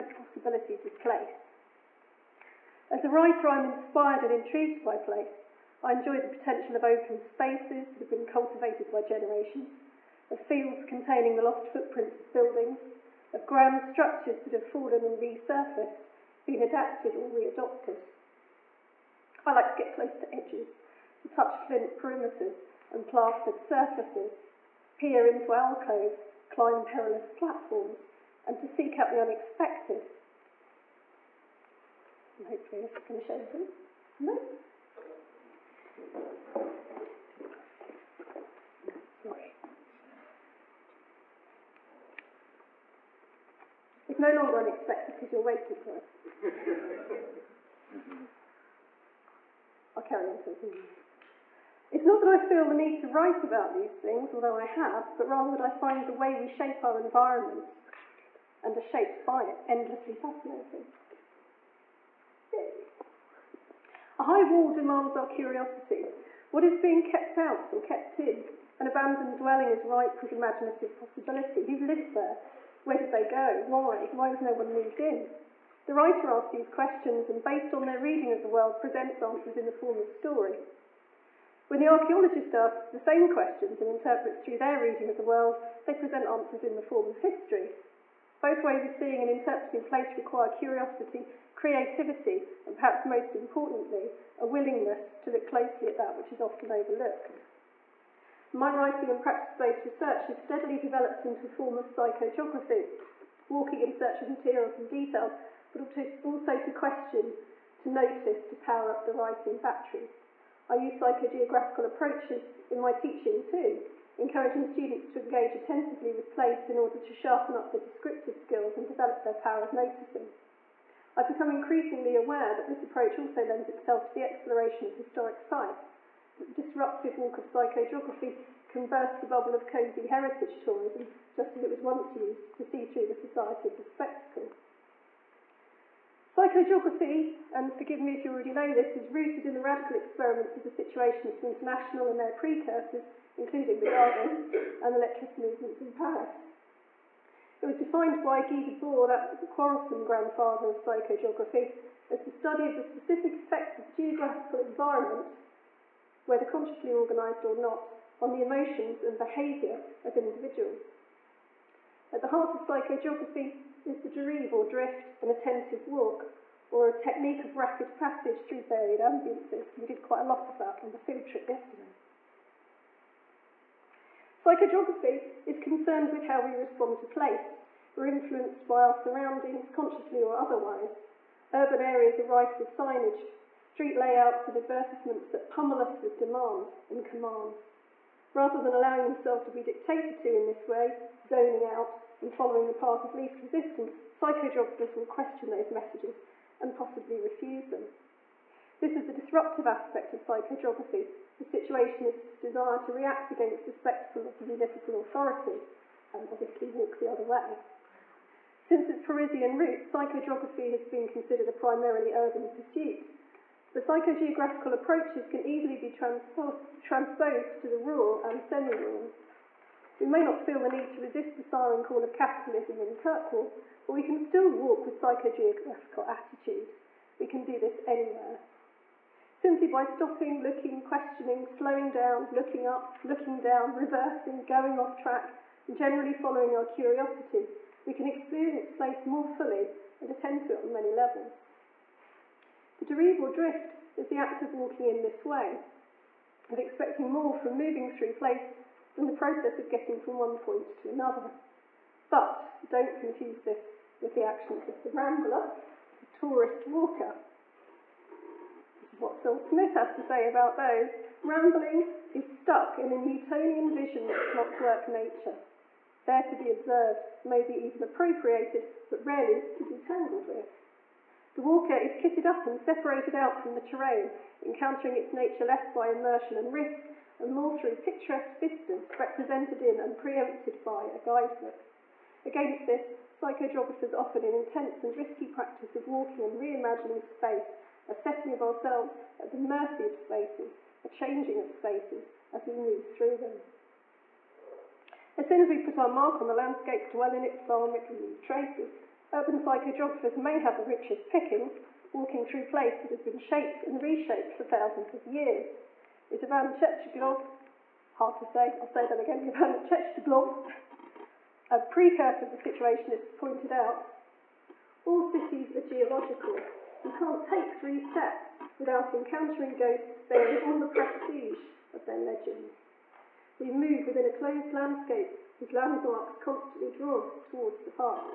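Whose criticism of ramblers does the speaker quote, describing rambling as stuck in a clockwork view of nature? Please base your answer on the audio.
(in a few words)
Phil Smith.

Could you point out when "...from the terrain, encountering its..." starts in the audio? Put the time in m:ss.
4:33.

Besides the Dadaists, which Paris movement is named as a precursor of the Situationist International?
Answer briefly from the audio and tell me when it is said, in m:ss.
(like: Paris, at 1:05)
Lettrist movements, at 2:24.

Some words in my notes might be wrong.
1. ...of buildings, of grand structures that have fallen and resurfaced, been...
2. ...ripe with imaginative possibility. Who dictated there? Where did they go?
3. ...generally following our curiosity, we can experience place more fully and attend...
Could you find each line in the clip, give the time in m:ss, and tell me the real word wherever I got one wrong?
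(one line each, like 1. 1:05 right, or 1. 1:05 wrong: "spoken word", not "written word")
1. 0:12 right
2. 1:09 wrong: "lived", not "dictated"
3. 3:55 right.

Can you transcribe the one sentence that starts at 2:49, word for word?
We did quite a lot of that on the field trip yesterday.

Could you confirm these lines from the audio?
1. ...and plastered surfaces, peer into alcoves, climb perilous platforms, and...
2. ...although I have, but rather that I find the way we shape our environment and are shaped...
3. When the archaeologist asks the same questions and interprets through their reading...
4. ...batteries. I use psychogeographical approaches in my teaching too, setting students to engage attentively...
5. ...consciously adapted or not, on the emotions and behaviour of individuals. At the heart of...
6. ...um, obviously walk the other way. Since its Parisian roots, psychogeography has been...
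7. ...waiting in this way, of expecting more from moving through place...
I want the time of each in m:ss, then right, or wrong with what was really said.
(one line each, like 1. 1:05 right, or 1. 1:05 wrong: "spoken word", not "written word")
1. 0:22 right
2. 0:54 right
3. 1:21 right
4. 1:49 wrong: "encouraging", not "setting"
5. 2:36 wrong: "organised", not "adapted"
6. 3:26 right
7. 4:04 wrong: "walking", not "waiting".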